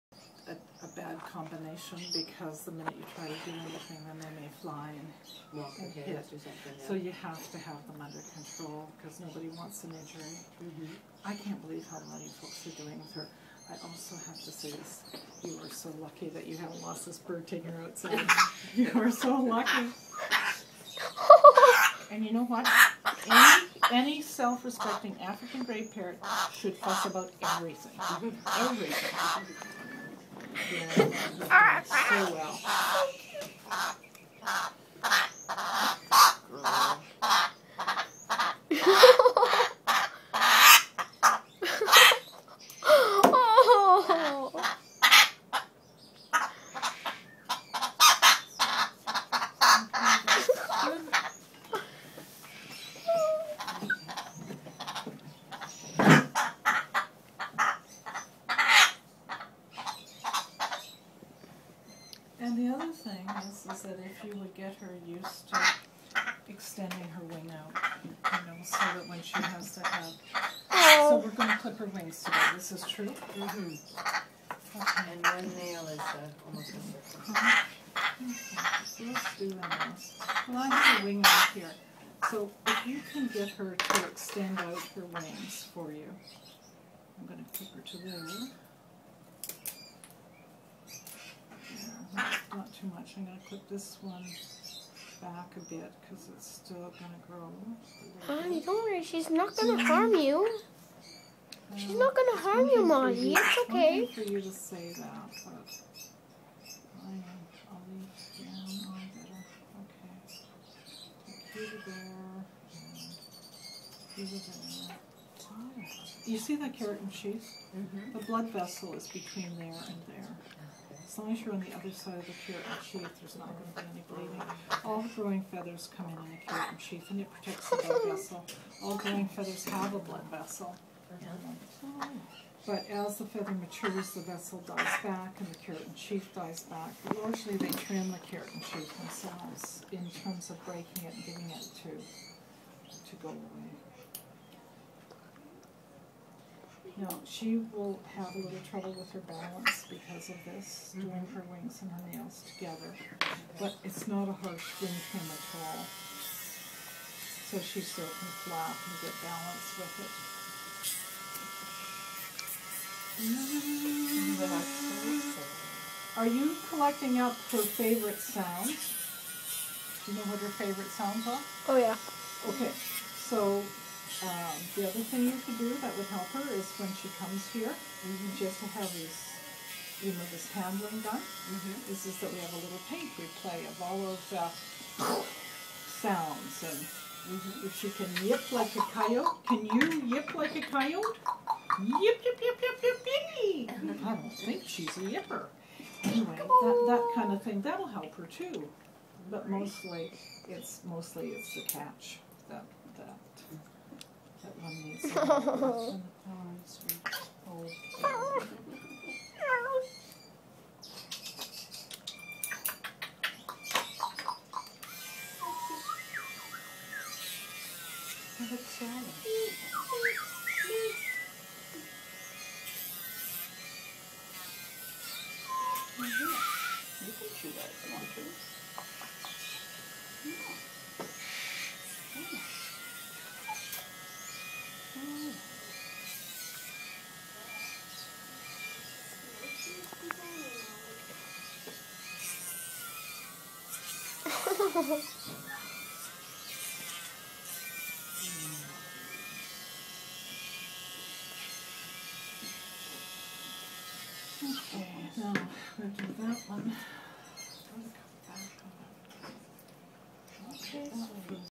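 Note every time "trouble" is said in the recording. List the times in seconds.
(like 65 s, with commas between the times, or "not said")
148 s.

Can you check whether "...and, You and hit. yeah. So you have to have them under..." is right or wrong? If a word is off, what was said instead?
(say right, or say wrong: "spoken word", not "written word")
wrong: "Walk", not "You".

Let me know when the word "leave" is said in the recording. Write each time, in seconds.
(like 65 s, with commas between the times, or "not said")
107 s.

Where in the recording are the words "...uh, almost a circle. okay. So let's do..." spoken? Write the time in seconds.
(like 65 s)
75 s.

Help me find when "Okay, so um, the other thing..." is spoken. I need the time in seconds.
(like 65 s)
172 s.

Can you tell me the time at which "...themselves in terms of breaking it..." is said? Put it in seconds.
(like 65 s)
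138 s.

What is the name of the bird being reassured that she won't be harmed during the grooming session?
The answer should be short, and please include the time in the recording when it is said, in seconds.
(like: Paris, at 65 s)
Molly, at 102 s.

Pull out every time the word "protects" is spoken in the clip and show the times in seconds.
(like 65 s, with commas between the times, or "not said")
127 s.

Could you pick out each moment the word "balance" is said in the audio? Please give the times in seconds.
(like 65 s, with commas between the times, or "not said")
149 s, 159 s.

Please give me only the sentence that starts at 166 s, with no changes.
Are you collecting up her favorite sounds?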